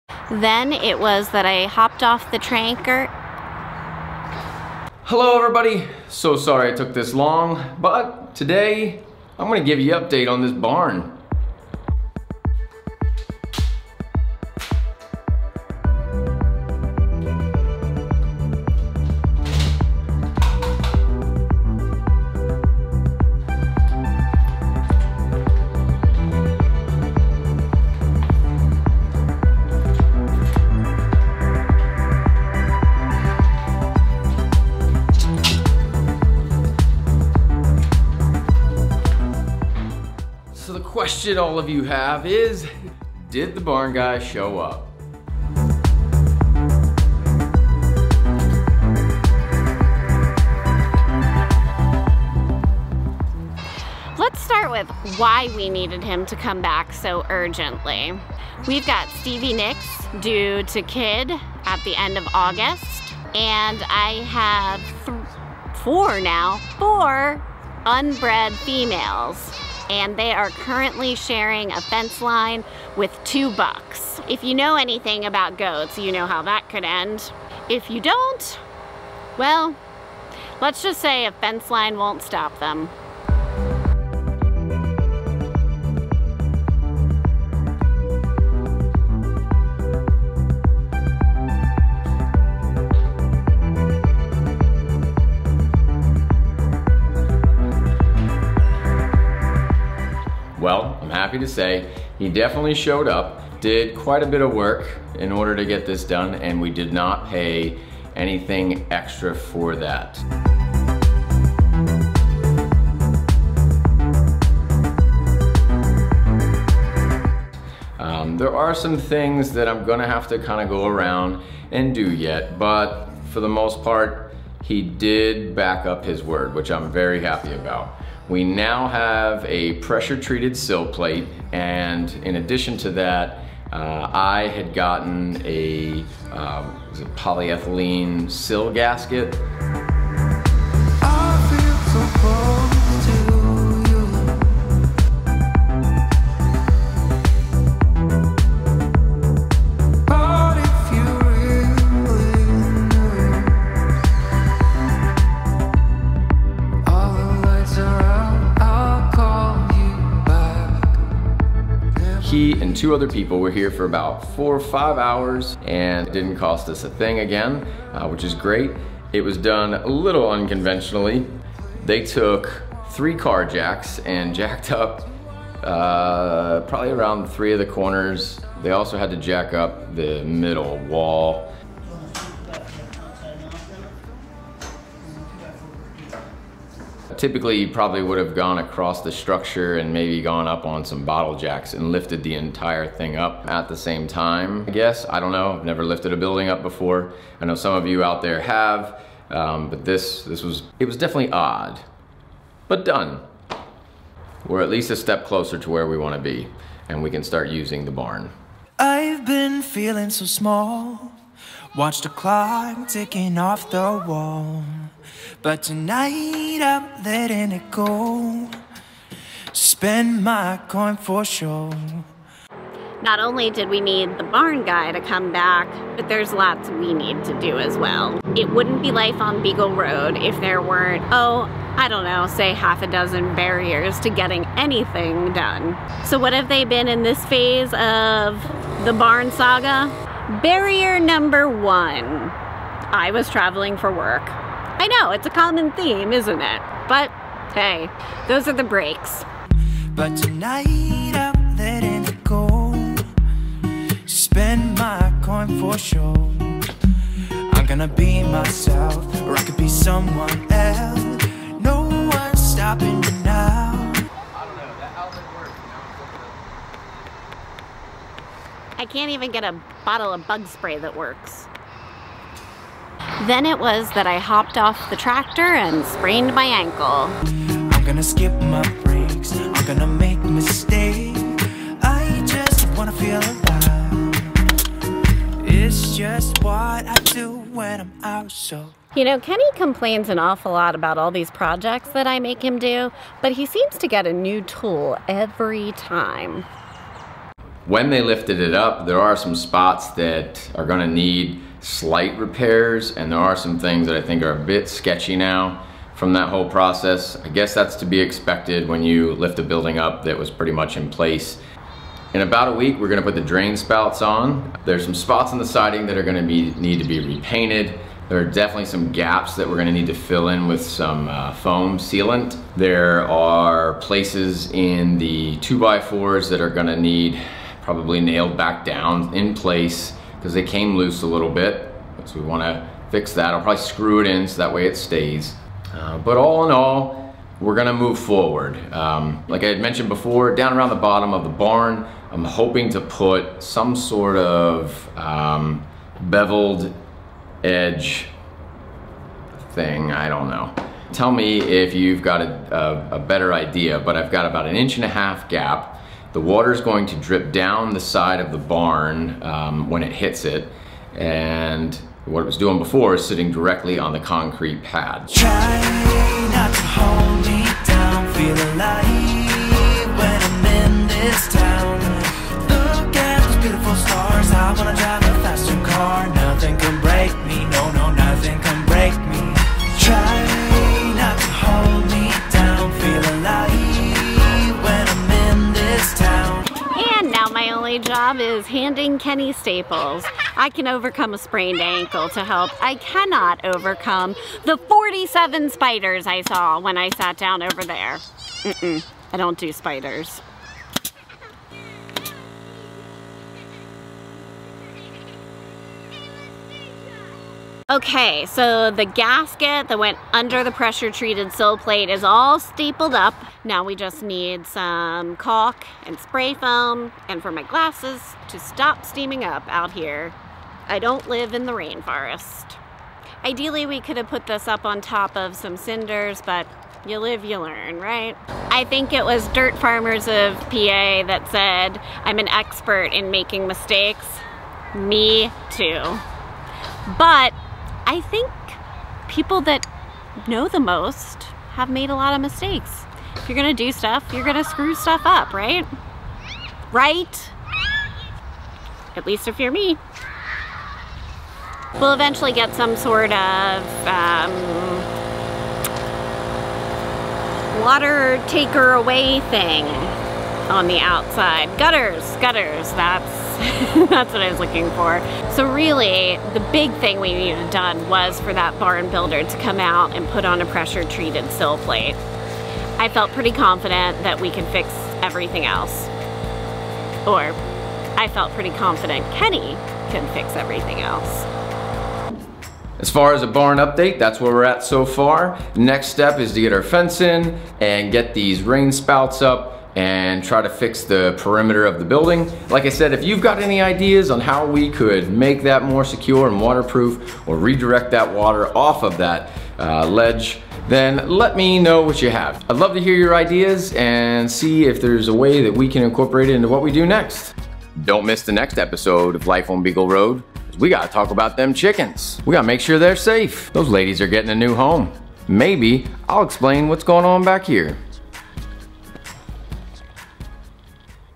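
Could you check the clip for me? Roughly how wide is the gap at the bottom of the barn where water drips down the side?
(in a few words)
an inch and a half.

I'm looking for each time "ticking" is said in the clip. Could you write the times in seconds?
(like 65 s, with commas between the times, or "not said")
212 s.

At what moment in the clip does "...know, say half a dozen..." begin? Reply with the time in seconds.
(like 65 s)
232 s.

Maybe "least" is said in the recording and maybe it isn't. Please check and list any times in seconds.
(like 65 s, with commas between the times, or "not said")
204 s, 449 s.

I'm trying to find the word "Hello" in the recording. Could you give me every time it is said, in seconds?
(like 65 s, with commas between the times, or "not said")
5 s.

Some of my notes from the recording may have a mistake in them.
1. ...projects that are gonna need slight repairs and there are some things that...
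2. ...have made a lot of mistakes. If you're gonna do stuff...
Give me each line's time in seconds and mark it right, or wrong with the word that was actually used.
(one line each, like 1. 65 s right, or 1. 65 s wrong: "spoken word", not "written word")
1. 299 s wrong: "spots", not "projects"
2. 441 s right.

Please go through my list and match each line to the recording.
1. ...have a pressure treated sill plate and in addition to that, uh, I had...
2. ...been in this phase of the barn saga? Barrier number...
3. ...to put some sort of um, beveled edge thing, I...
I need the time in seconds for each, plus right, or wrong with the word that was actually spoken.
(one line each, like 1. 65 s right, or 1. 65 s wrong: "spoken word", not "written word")
1. 128 s right
2. 236 s right
3. 342 s right.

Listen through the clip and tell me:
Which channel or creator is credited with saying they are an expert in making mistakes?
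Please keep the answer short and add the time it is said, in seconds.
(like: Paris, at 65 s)
Dirt Farmers of PA, at 429 s.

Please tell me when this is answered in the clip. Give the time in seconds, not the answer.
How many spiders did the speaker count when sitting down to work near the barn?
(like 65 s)
394 s.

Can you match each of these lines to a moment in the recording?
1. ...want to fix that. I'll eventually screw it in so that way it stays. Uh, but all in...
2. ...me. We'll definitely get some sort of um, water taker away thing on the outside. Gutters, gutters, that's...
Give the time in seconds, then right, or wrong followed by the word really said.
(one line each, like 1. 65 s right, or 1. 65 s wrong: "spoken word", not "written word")
1. 332 s wrong: "probably", not "eventually"
2. 449 s wrong: "eventually", not "definitely".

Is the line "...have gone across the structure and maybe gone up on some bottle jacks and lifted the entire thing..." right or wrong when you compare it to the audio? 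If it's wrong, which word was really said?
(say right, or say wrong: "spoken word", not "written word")
right.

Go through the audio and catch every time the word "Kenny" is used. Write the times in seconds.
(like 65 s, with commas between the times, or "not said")
289 s, 388 s, 479 s.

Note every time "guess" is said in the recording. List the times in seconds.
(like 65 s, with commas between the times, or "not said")
194 s, 307 s.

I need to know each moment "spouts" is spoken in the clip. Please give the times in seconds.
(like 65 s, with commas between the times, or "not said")
313 s, 488 s.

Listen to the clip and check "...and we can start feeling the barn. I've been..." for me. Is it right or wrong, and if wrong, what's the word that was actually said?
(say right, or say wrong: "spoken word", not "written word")
wrong: "using", not "feeling".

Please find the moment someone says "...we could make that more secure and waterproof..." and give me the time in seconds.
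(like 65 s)
494 s.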